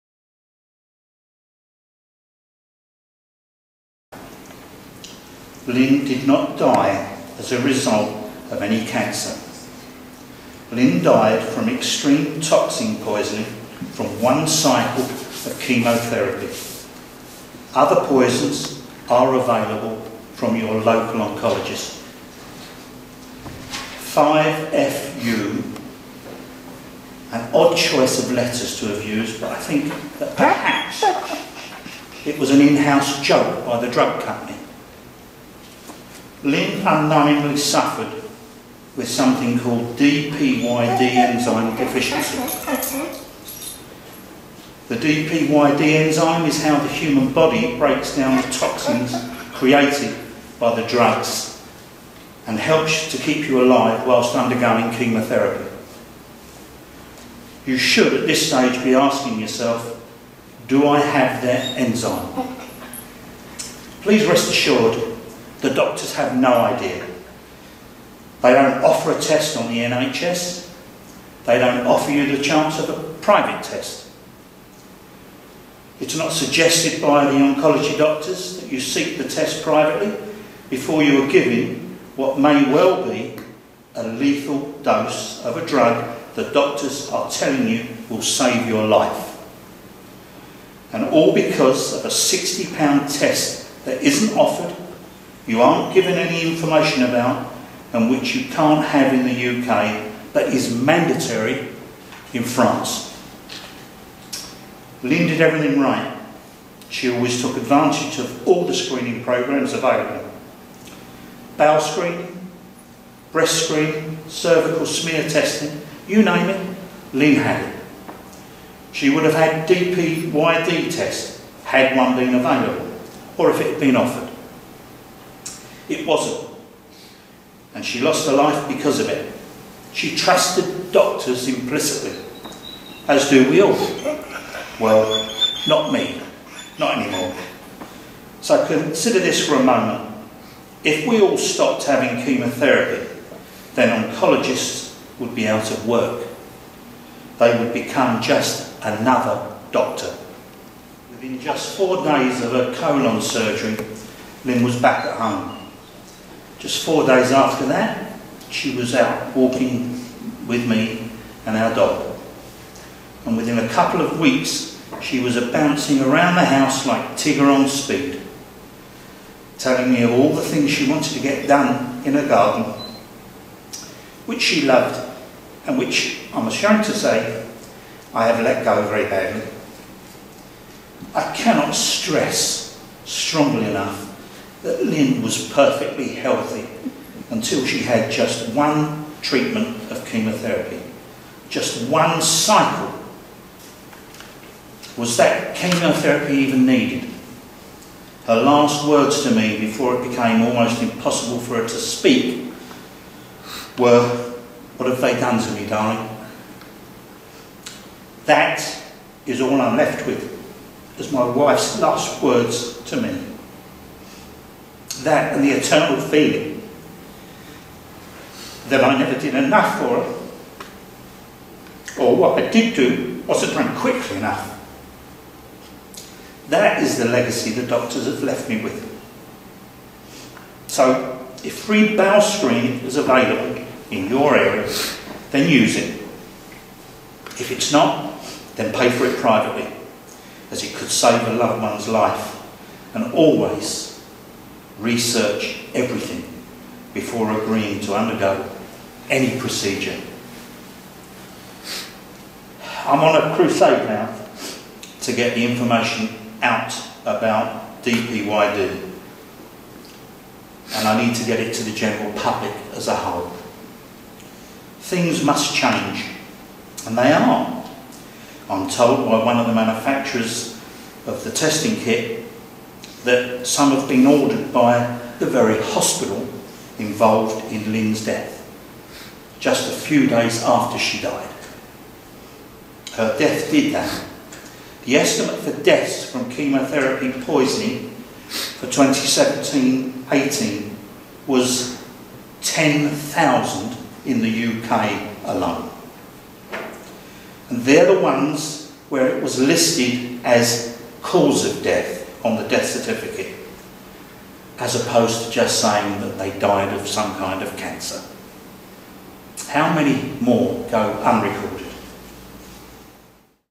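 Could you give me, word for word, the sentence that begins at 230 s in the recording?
So, if free bowel screening is available in your area, then use it.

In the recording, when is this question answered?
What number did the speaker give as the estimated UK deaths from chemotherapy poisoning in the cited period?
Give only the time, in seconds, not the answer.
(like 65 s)
292 s.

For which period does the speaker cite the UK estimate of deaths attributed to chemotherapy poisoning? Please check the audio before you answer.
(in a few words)
2017-18.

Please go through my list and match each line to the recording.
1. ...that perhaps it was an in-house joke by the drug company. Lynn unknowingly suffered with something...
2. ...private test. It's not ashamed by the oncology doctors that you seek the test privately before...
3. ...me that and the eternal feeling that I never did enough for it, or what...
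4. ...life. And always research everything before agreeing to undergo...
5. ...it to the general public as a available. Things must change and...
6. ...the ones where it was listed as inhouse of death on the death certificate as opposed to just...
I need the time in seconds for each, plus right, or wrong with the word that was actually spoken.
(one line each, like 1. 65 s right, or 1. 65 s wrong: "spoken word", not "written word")
1. 30 s right
2. 73 s wrong: "suggested", not "ashamed"
3. 213 s right
4. 241 s right
5. 261 s wrong: "whole", not "available"
6. 297 s wrong: "cause", not "inhouse".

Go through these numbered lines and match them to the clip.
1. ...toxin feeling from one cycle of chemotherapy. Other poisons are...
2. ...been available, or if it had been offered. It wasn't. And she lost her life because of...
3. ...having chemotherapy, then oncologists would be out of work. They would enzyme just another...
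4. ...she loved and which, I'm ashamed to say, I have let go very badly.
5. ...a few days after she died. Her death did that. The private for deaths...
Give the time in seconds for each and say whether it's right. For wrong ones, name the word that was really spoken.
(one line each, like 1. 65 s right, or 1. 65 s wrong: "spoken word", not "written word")
1. 12 s wrong: "poisoning", not "feeling"
2. 122 s right
3. 141 s wrong: "become", not "enzyme"
4. 174 s right
5. 279 s wrong: "estimate", not "private".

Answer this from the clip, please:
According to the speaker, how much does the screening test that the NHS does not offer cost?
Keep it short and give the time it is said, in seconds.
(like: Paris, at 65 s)
£60, at 92 s.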